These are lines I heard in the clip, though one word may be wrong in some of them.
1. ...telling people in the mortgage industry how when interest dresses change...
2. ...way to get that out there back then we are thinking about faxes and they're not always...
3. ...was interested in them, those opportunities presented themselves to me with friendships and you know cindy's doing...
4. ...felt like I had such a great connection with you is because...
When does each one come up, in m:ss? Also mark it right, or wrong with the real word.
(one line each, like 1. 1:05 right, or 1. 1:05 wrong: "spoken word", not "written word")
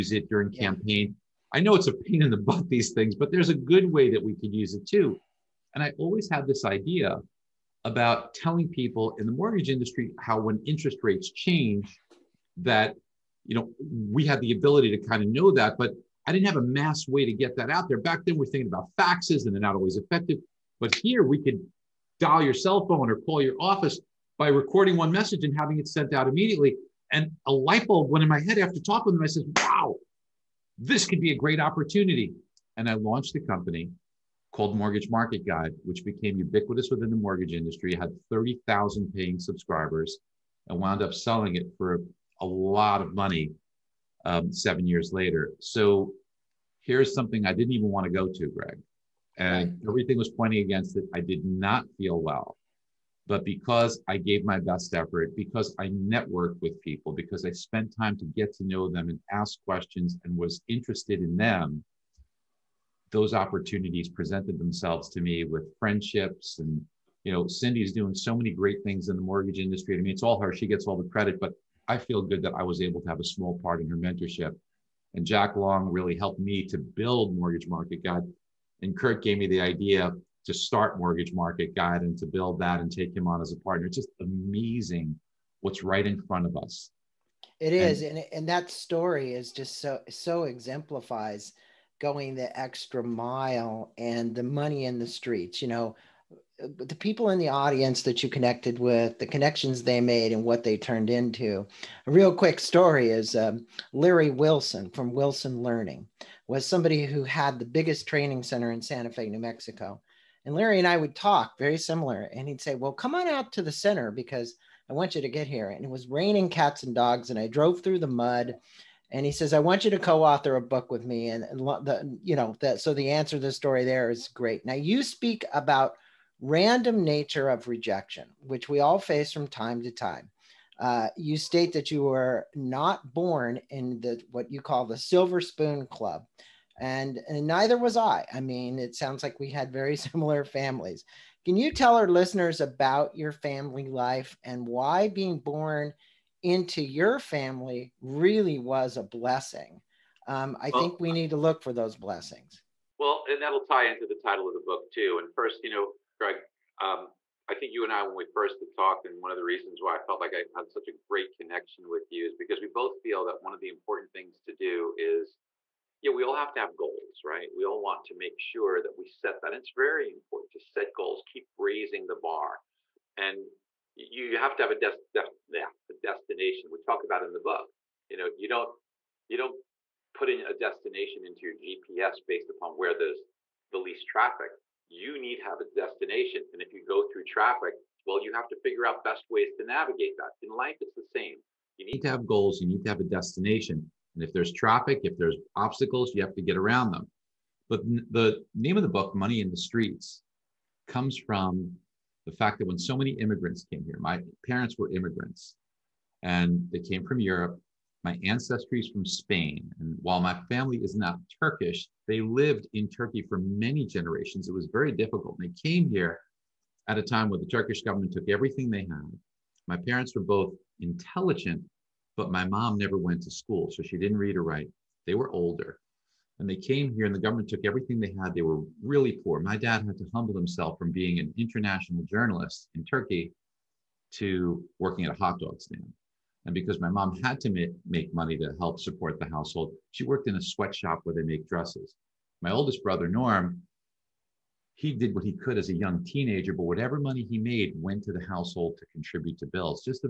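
1. 0:08 wrong: "rates", not "dresses"
2. 0:17 right
3. 1:00 right
4. 2:40 right.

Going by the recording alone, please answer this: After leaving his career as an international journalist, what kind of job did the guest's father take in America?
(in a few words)
Hot dog stand.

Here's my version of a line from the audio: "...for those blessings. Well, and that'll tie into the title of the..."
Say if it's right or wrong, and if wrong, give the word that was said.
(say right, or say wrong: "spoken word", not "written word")
right.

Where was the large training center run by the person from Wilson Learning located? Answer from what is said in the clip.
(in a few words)
Santa Fe, New Mexico.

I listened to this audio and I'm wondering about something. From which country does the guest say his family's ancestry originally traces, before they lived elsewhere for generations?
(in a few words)
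Spain.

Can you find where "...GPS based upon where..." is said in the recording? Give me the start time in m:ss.
3:01.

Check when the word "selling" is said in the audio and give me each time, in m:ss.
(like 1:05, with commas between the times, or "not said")
0:41.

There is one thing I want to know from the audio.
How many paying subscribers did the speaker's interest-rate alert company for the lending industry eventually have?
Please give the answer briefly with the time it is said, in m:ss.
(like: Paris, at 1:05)
30,000, at 0:38.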